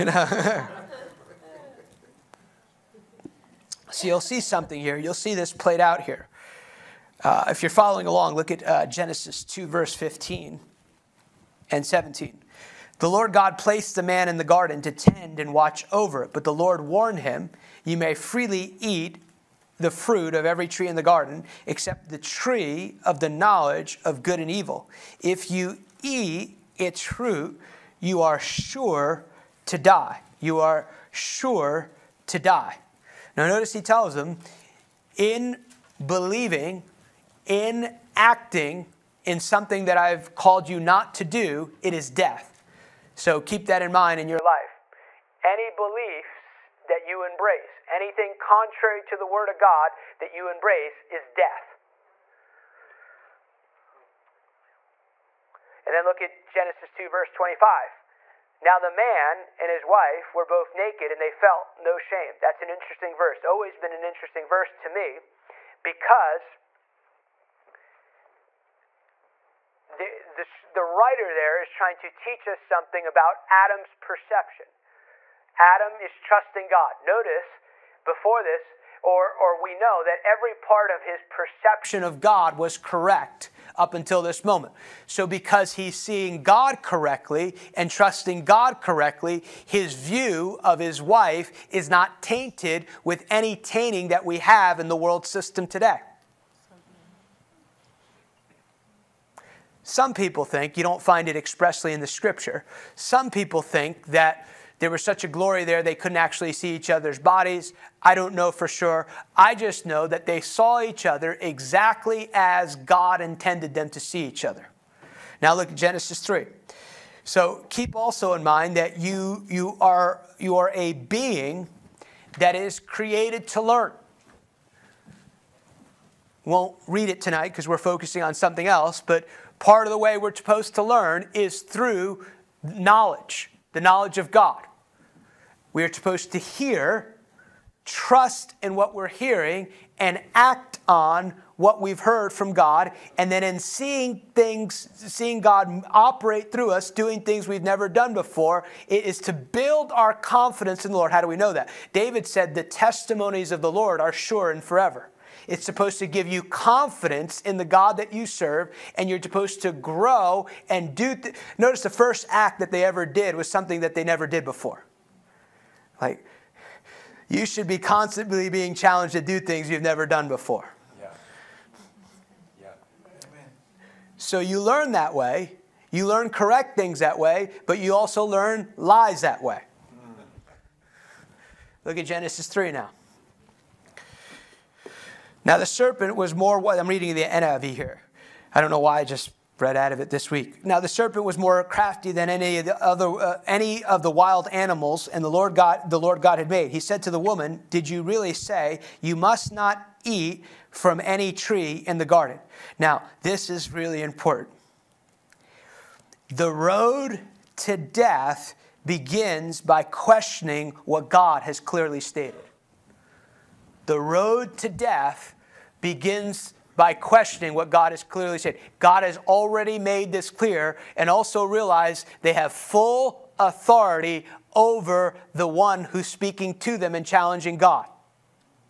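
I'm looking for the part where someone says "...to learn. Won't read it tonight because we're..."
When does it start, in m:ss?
2:03.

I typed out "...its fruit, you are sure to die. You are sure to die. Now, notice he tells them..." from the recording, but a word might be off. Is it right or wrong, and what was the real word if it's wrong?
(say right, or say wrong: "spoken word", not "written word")
right.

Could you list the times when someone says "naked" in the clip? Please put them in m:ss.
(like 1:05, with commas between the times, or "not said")
1:00.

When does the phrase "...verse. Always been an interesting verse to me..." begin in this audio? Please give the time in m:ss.
1:03.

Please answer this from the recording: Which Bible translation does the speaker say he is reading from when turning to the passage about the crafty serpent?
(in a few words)
NIV.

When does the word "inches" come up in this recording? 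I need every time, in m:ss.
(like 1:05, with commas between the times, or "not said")
not said.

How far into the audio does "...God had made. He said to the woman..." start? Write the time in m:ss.
3:16.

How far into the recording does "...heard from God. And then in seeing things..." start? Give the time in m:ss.
2:21.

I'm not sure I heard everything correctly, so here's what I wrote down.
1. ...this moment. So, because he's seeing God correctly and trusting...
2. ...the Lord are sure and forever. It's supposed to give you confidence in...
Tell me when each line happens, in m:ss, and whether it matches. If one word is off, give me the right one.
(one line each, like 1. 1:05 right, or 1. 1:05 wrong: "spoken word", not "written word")
1. 1:24 right
2. 2:33 right.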